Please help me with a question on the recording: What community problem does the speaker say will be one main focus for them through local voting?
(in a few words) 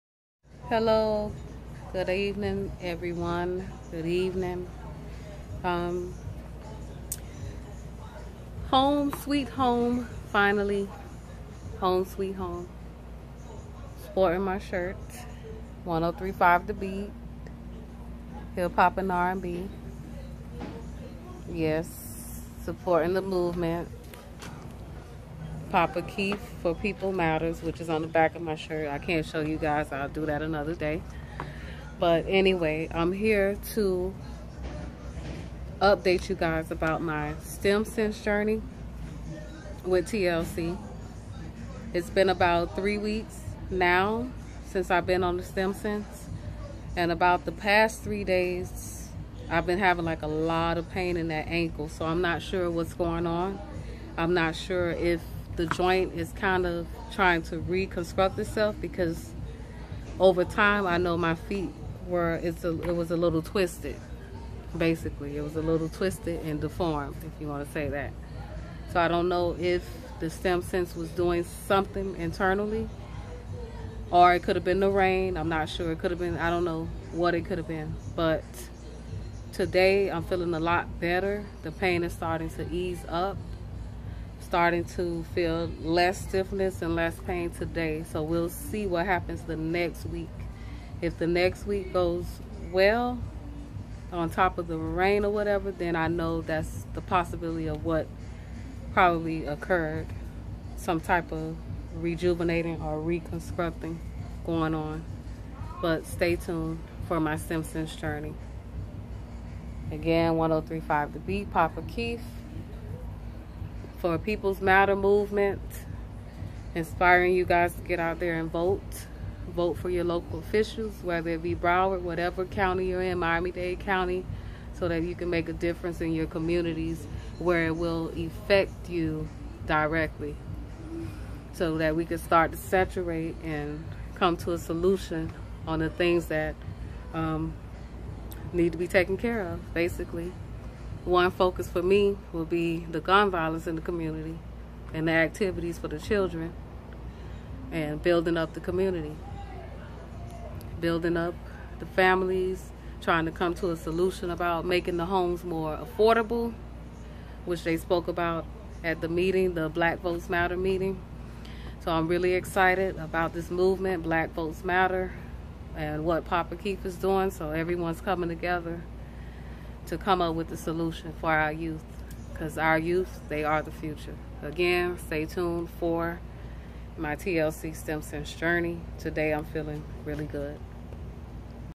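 Gun violence.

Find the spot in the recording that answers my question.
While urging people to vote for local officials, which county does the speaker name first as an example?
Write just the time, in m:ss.
2:01.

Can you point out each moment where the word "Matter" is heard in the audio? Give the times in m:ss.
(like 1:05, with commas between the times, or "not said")
0:27, 1:54, 2:40, 2:44.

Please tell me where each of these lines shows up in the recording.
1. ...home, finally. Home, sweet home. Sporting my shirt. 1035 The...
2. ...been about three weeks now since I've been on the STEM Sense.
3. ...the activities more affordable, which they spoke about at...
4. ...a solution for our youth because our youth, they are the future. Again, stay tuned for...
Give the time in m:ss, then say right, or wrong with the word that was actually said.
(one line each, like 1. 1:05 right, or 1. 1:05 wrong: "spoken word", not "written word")
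1. 0:09 right
2. 0:42 right
3. 2:34 wrong: "homes", not "activities"
4. 2:50 right.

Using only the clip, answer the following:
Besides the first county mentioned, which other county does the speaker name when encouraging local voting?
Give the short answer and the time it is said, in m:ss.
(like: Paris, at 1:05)
Miami-Dade County, at 2:03.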